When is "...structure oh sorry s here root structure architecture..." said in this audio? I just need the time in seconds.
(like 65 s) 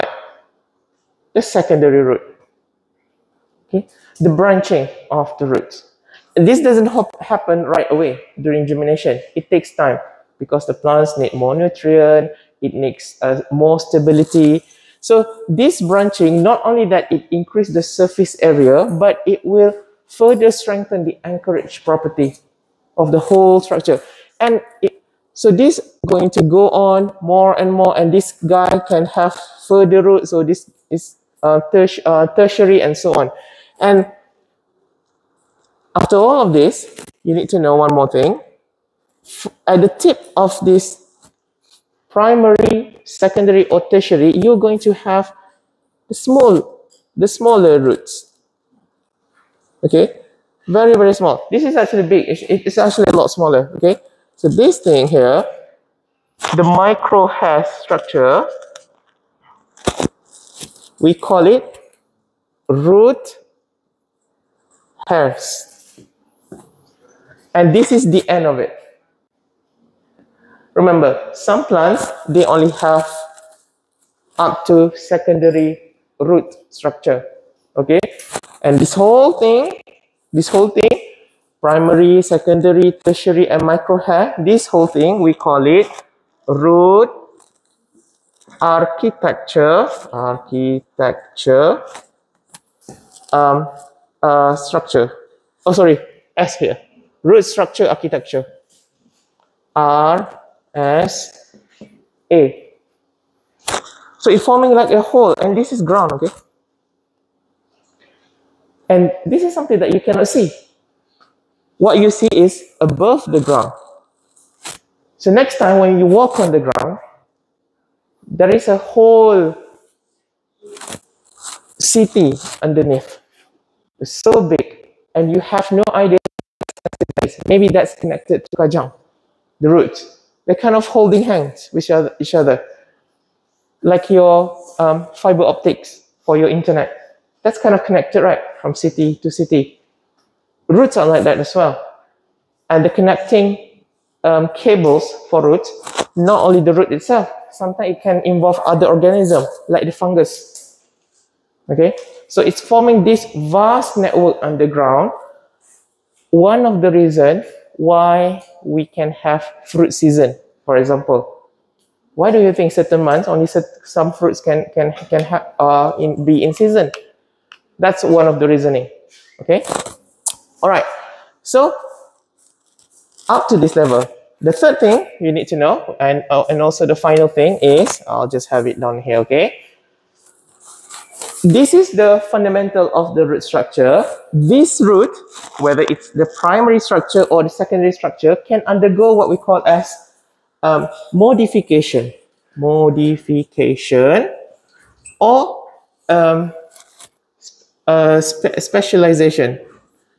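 94 s.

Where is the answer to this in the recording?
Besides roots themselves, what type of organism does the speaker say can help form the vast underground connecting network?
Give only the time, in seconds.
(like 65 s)
149 s.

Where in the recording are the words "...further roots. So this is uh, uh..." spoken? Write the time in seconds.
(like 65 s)
29 s.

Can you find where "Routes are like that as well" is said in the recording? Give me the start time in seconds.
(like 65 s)
140 s.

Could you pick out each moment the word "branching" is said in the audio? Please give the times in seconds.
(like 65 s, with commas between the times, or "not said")
4 s, 15 s.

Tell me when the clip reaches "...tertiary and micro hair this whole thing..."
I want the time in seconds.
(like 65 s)
83 s.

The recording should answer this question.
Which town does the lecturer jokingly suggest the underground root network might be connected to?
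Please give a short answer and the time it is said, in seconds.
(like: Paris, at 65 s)
Kajang, at 128 s.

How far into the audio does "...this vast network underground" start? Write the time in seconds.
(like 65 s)
153 s.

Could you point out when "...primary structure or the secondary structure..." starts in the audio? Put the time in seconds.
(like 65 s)
186 s.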